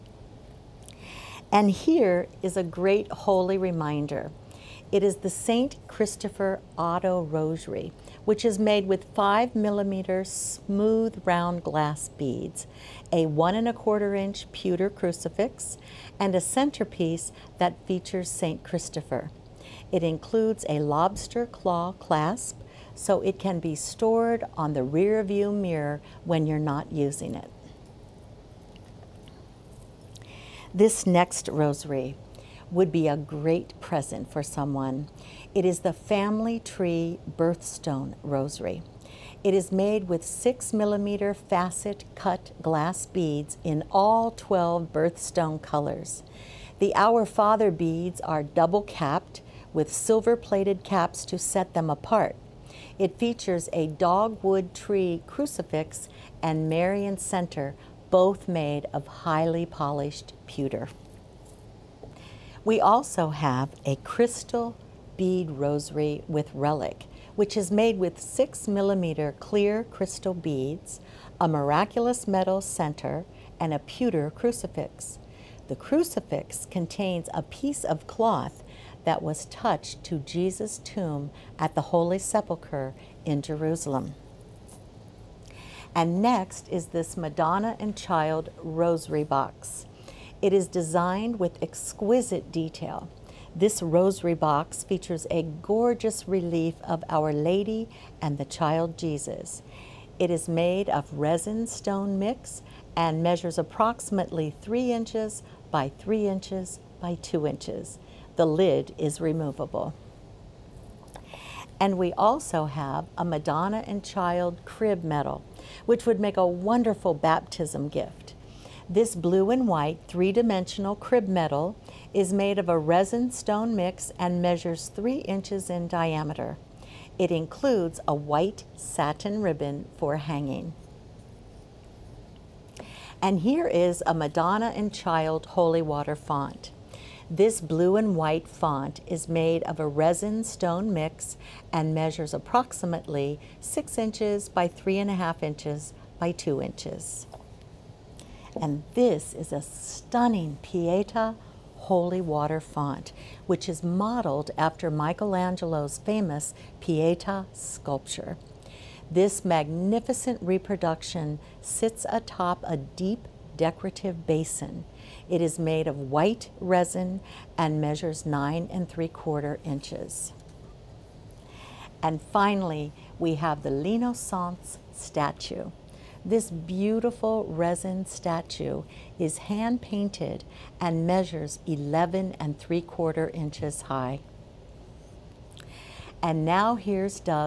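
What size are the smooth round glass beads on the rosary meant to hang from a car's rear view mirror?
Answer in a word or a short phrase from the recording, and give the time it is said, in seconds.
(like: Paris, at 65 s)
5 millimeter, at 9 s.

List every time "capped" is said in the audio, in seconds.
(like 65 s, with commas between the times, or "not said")
48 s.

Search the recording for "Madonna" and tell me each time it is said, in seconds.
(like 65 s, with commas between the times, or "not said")
87 s, 113 s, 134 s.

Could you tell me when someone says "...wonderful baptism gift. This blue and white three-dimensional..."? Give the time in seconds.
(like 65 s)
116 s.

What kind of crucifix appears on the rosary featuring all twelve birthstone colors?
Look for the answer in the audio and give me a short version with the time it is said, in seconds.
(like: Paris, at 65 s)
Dogwood tree crucifix, at 53 s.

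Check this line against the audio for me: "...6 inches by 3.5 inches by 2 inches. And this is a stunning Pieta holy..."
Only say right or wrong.
right.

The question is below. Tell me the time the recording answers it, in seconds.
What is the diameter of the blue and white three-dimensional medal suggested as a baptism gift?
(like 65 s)
124 s.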